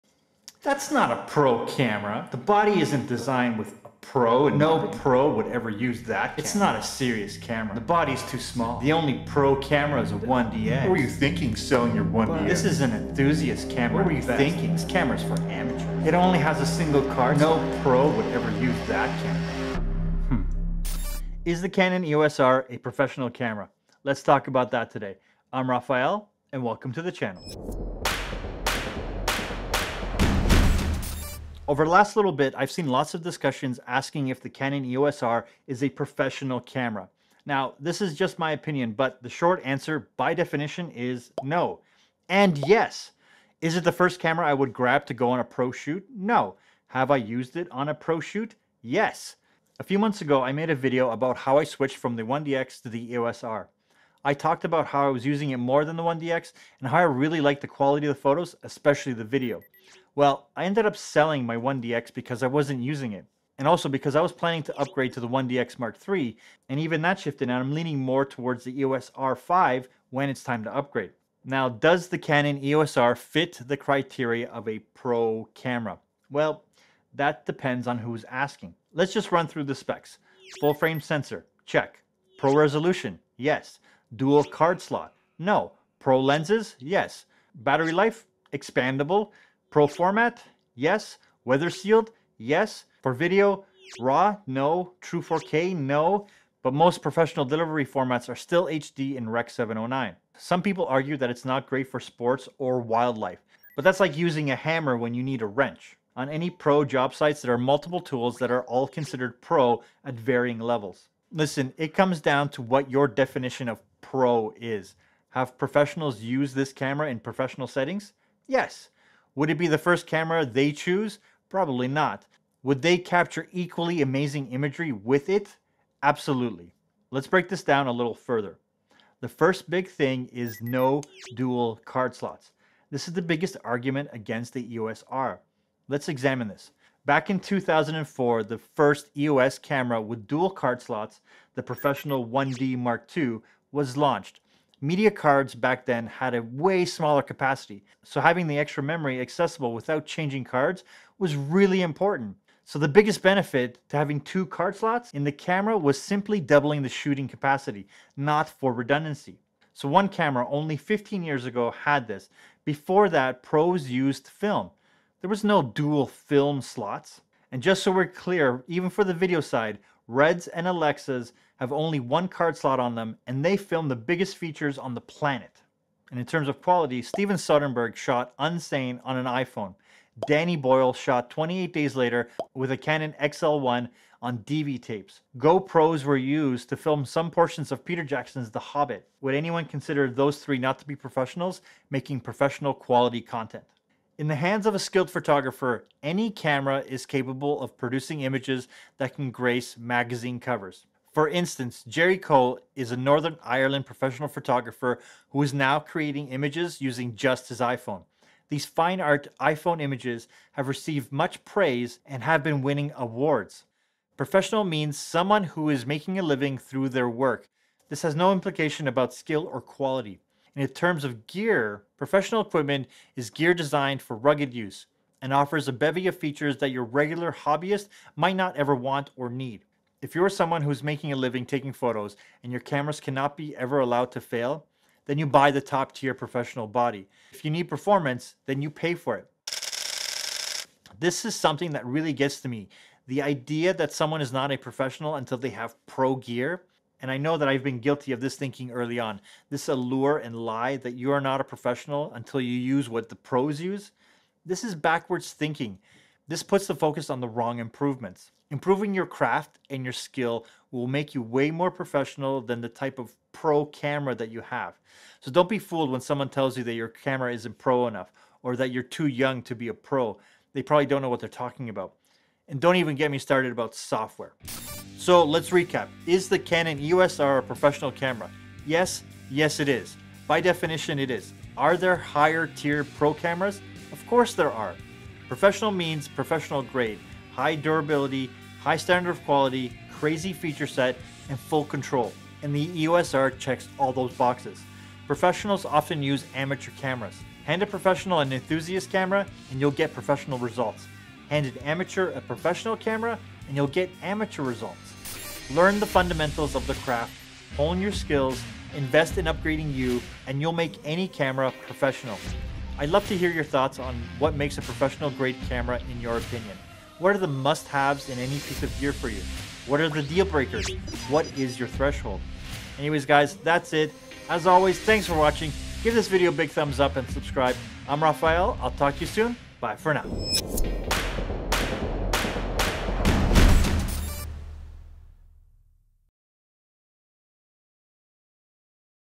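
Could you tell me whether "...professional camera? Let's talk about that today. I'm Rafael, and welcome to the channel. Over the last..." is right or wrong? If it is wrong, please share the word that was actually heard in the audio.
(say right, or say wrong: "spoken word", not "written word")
right.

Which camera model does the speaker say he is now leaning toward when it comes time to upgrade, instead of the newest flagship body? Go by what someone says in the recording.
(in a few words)
EOS R5.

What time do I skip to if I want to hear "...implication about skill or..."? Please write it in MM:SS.
03:38.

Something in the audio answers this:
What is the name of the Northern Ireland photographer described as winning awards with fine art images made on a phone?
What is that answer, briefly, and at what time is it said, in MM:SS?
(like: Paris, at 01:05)
Jerry Cole, at 03:21.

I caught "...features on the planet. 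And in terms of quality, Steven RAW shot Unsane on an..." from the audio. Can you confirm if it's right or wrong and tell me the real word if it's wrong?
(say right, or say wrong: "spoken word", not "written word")
wrong: "Soderbergh", not "RAW".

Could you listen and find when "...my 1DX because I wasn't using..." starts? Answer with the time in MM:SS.
01:01.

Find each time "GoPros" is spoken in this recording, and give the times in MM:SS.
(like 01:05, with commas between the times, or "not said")
03:05.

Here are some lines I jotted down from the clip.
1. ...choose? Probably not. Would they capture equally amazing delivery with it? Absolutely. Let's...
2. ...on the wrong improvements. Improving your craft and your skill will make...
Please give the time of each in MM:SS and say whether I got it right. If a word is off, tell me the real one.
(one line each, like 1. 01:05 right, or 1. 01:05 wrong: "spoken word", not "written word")
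1. 02:00 wrong: "imagery", not "delivery"
2. 04:17 right.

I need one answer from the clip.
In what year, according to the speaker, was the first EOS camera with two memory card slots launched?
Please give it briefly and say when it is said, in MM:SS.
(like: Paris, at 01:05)
2004, at 02:17.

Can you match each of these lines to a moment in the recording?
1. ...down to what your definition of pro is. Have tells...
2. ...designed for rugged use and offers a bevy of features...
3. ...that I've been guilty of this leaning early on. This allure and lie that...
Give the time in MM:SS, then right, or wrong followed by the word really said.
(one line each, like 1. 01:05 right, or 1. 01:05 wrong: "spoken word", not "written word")
1. 01:52 wrong: "professionals", not "tells"
2. 03:43 right
3. 04:07 wrong: "thinking", not "leaning".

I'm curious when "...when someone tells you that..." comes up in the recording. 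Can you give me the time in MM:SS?
04:25.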